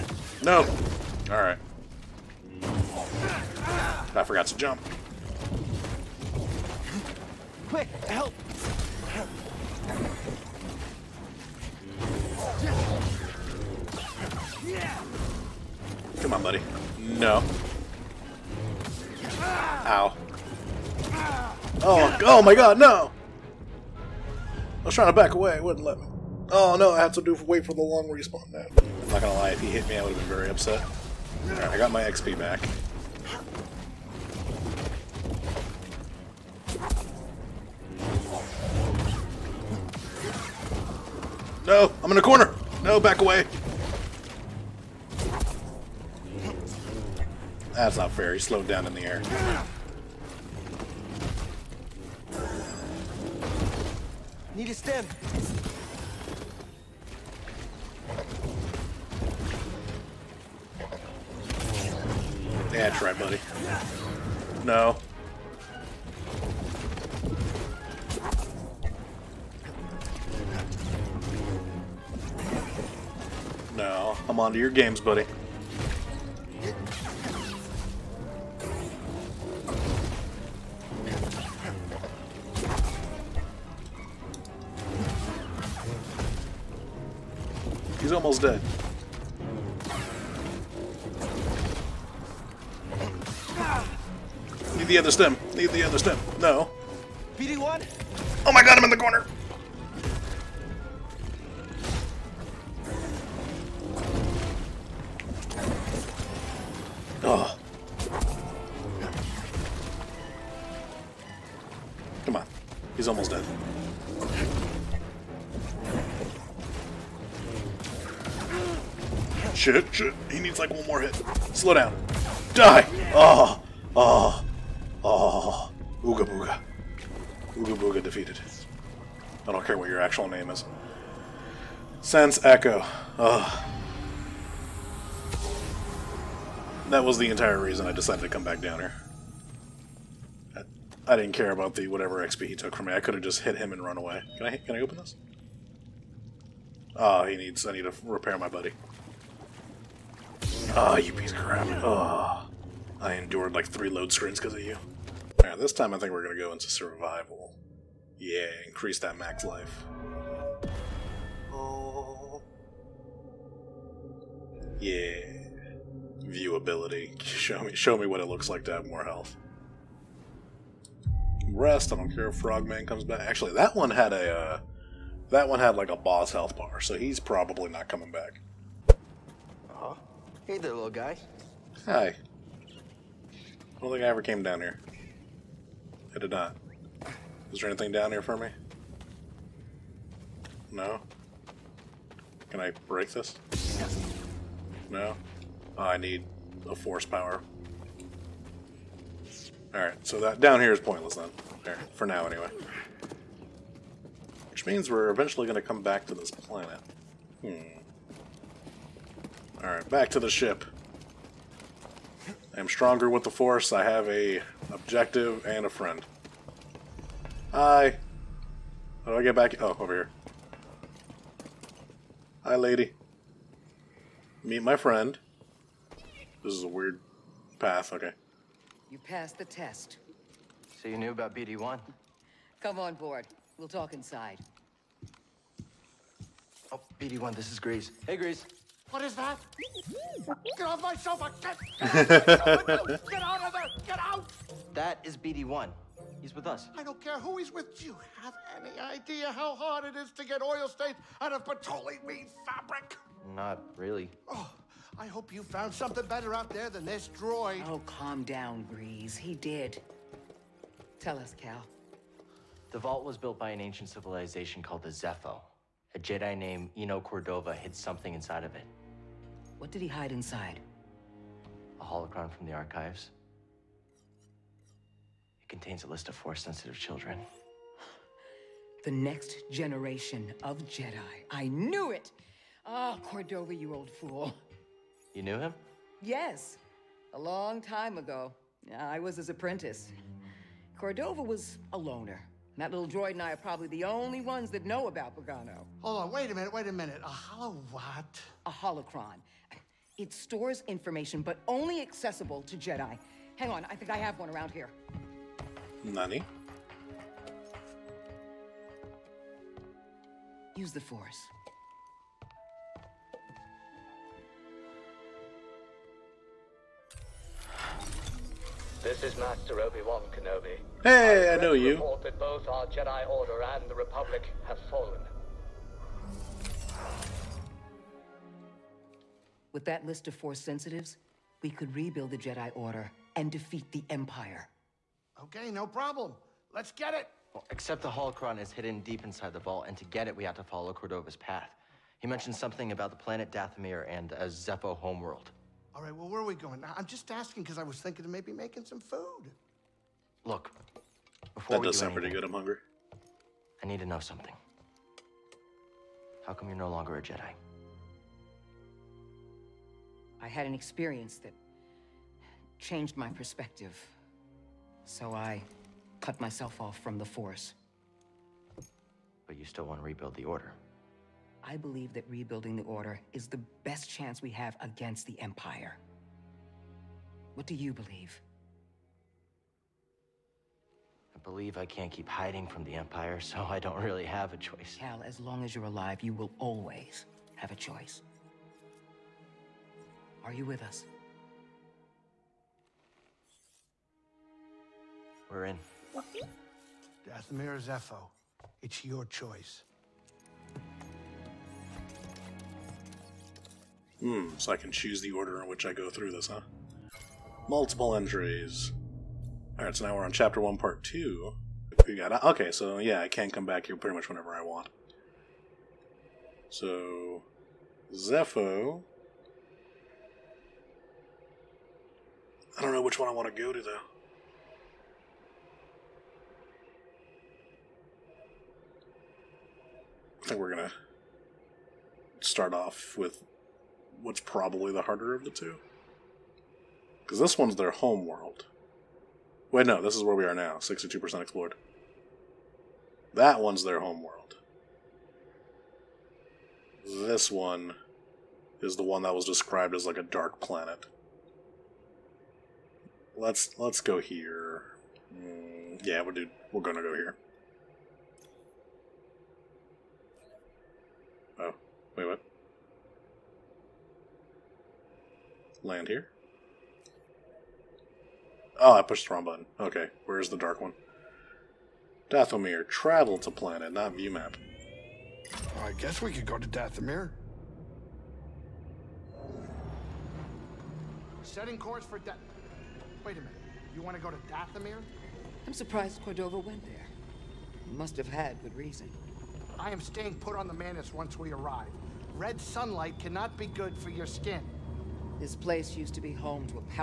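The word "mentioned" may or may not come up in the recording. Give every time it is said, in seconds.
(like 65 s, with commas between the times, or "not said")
342 s.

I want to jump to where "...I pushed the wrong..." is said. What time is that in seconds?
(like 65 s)
468 s.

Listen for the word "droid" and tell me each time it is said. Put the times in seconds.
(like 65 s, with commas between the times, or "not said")
257 s, 292 s.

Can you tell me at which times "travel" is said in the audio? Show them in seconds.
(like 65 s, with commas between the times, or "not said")
472 s.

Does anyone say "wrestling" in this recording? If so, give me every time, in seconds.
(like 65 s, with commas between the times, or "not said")
not said.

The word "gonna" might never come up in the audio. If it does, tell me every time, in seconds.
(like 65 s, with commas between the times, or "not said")
29 s, 456 s.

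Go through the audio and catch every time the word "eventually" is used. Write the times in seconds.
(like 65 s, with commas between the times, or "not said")
205 s.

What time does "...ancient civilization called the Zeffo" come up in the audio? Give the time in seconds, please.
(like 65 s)
263 s.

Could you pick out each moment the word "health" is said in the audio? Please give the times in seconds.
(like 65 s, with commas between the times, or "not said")
169 s, 176 s.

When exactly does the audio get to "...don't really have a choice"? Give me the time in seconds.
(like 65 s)
383 s.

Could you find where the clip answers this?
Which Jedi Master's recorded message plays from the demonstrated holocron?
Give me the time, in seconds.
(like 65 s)
319 s.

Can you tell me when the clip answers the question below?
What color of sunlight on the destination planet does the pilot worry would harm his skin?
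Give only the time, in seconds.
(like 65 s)
492 s.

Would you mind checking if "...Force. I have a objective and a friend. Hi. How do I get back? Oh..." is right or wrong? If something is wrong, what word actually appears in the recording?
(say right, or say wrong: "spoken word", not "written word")
right.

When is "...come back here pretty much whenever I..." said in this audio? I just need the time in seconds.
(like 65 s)
413 s.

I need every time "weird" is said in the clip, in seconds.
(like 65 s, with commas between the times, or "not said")
226 s.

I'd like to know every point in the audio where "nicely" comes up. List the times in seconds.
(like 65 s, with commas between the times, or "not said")
not said.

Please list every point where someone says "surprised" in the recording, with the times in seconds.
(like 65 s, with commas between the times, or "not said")
485 s.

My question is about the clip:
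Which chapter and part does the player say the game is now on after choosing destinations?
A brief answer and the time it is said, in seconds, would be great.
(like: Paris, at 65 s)
Chapter 1, Part 2, at 410 s.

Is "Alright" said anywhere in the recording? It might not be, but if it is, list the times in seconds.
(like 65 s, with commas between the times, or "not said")
1 s, 31 s, 155 s, 199 s, 209 s, 409 s.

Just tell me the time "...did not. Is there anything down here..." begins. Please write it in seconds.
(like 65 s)
186 s.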